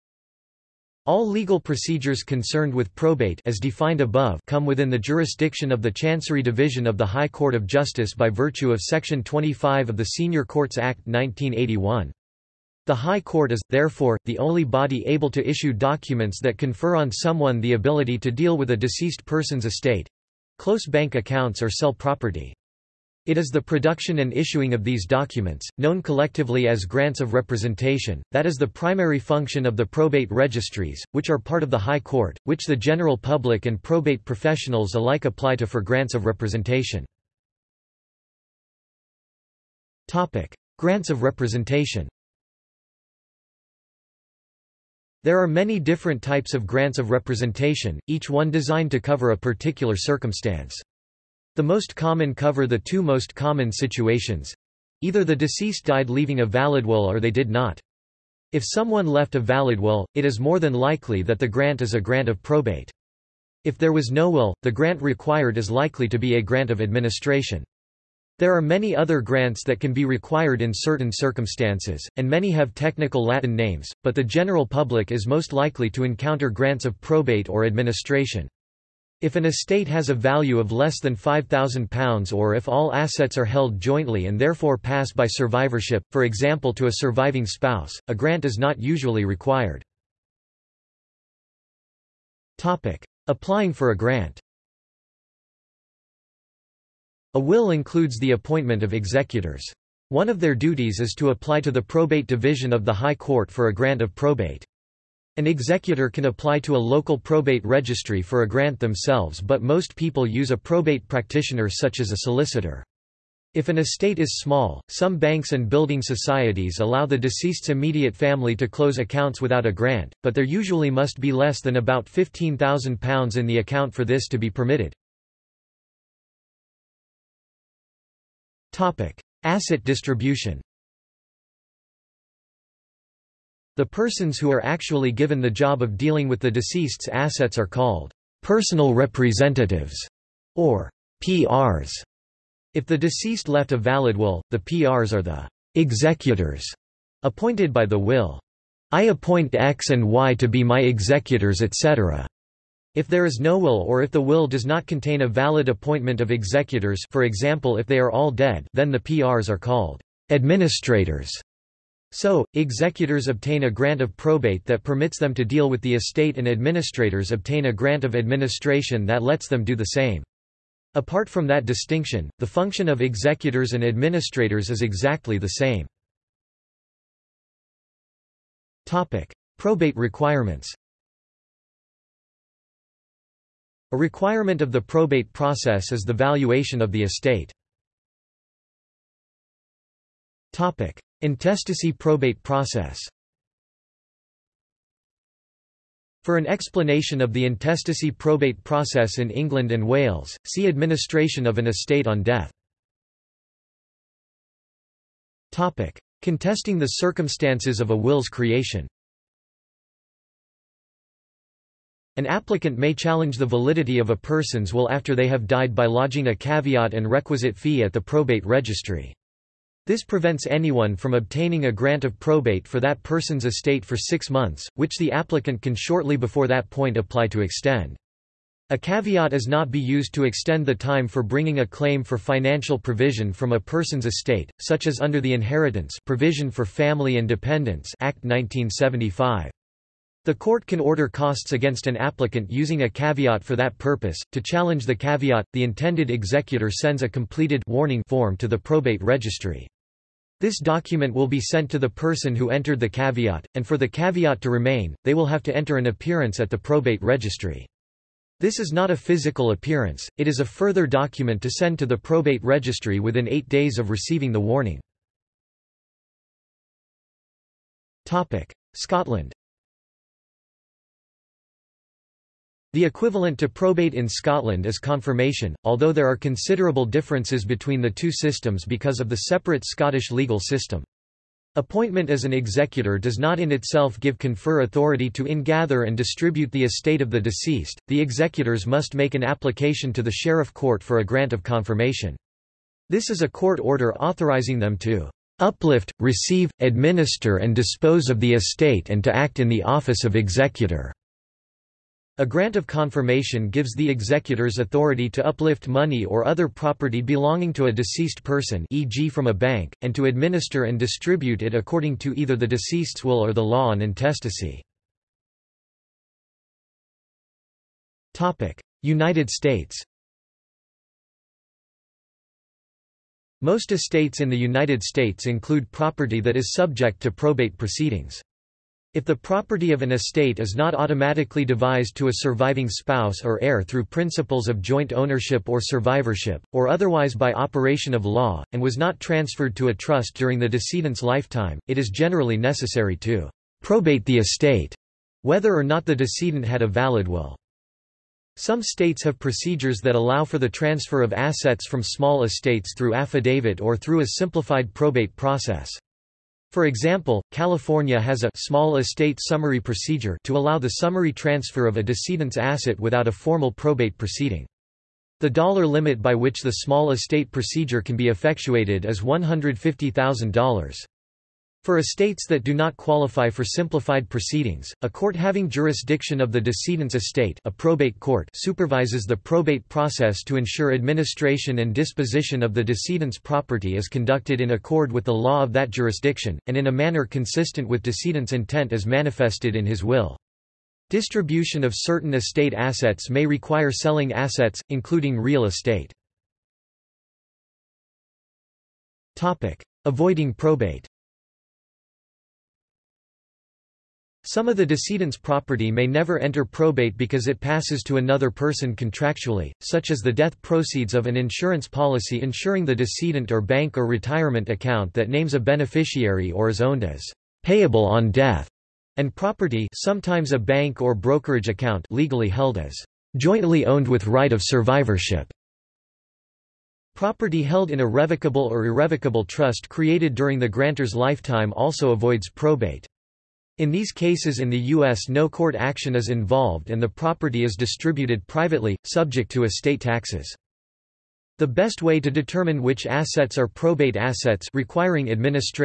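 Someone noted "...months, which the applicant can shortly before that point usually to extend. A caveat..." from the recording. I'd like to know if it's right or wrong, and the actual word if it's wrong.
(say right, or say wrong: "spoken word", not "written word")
wrong: "apply", not "usually".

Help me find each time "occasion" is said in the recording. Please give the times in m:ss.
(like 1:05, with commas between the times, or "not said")
not said.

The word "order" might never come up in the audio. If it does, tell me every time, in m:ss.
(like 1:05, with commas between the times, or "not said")
4:00, 4:53.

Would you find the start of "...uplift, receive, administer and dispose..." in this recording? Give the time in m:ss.
4:55.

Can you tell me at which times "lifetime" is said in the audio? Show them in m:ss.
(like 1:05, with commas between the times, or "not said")
5:41, 7:10.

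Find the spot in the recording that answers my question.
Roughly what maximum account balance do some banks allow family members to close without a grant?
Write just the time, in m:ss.
2:02.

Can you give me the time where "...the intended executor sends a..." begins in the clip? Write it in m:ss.
4:05.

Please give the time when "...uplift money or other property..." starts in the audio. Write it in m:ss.
5:05.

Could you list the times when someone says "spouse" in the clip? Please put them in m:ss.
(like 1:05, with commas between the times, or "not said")
1:27, 5:32.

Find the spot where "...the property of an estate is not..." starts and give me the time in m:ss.
5:29.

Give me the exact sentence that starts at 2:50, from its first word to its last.
Apart from that distinction, the function of executors and administrators is exactly the same.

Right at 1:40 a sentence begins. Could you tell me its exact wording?
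One of their duties is to apply to the probate division of the High Court for a grant of probate.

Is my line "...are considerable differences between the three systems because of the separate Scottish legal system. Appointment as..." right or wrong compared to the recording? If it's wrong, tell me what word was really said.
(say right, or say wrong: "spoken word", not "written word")
wrong: "two", not "three".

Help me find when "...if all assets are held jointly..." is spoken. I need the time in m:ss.
1:22.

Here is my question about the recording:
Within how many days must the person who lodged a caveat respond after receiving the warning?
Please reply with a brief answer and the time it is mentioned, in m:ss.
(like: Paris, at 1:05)
eight days, at 4:23.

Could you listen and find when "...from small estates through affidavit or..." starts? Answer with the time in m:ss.
5:51.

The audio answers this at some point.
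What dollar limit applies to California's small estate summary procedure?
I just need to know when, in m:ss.
6:08.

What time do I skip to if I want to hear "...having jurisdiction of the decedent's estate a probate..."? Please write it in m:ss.
6:15.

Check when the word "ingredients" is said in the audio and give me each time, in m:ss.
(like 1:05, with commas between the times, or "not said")
not said.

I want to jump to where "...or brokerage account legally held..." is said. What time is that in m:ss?
7:00.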